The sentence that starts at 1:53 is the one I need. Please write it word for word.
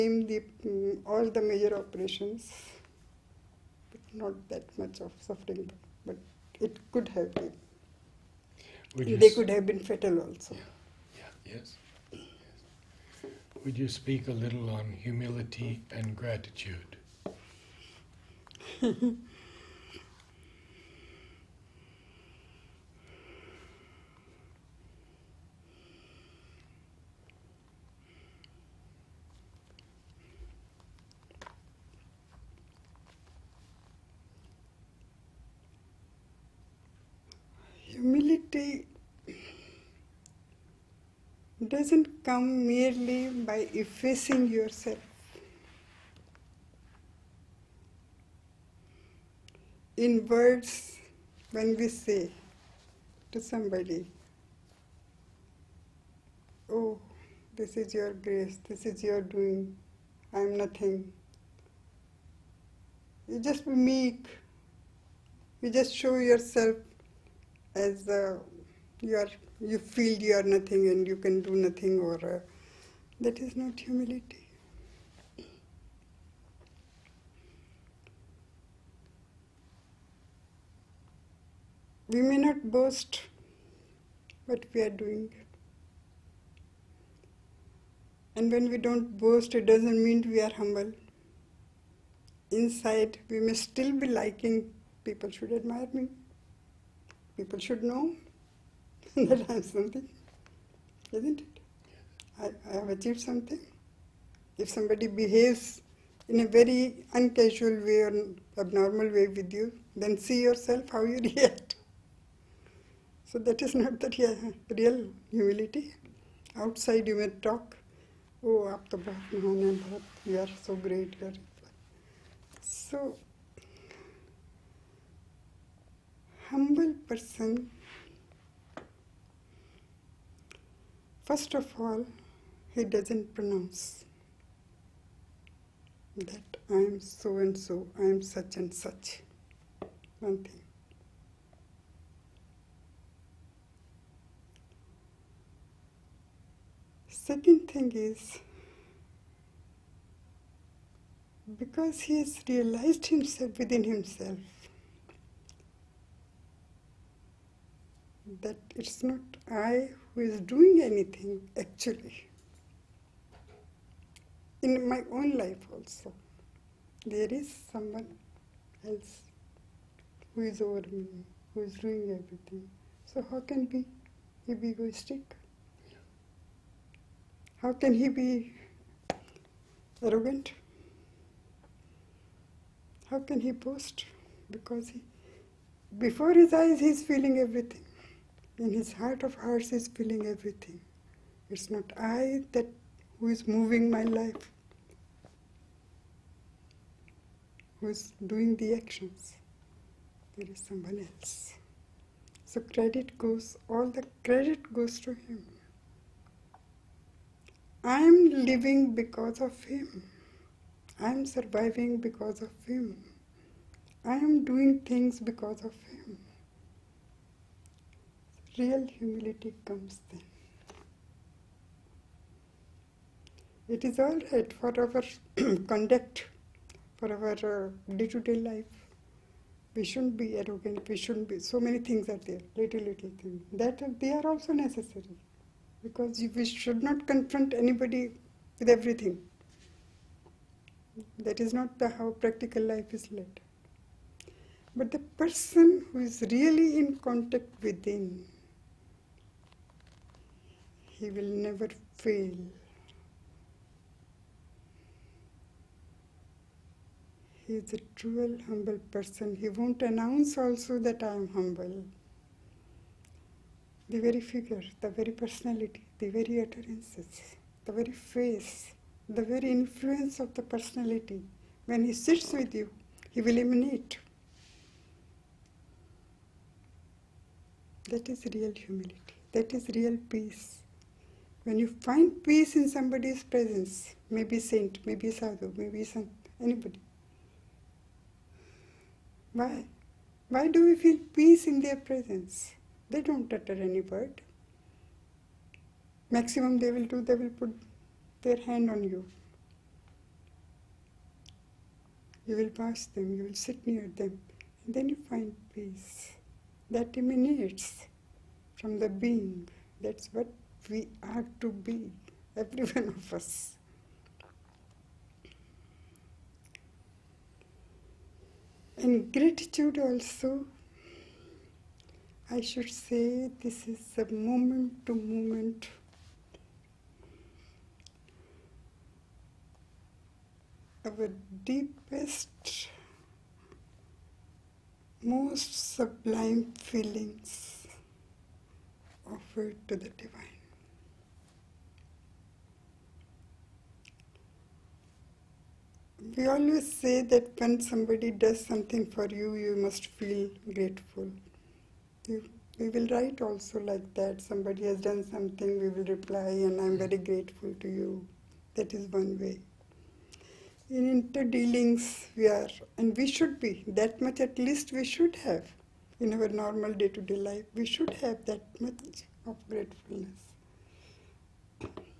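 So that is not the real, real humility.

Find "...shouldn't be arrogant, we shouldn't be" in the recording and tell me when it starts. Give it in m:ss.
3:49.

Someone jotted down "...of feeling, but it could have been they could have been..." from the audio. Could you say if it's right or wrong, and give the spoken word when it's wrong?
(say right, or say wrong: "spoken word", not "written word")
wrong: "suffering", not "feeling".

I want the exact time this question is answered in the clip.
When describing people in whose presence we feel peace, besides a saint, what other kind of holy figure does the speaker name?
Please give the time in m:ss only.
4:45.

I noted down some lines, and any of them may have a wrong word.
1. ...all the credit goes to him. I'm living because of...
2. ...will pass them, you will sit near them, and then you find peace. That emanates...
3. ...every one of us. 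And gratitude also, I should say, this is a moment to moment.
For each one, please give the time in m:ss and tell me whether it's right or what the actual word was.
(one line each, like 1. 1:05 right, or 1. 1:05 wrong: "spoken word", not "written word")
1. 3:23 right
2. 5:02 right
3. 5:12 right.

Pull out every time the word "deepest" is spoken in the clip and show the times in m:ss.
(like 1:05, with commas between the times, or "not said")
5:31.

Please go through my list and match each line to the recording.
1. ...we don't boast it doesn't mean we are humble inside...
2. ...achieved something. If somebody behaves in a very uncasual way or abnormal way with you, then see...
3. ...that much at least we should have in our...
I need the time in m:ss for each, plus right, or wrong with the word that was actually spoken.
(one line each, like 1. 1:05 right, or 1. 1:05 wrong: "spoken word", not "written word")
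1. 1:28 right
2. 1:42 right
3. 6:03 right.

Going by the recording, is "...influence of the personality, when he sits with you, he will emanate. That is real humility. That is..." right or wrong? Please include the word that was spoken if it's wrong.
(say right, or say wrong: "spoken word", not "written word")
right.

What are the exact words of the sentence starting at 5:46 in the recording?
We always say that when somebody does something for you, you must feel grateful.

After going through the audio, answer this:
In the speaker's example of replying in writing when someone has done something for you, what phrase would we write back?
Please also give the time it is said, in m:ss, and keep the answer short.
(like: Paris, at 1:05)
I'm very grateful to you, at 5:56.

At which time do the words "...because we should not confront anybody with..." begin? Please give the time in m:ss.
3:55.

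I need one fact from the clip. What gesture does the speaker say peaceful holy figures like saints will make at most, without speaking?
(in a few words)
put their hand on you.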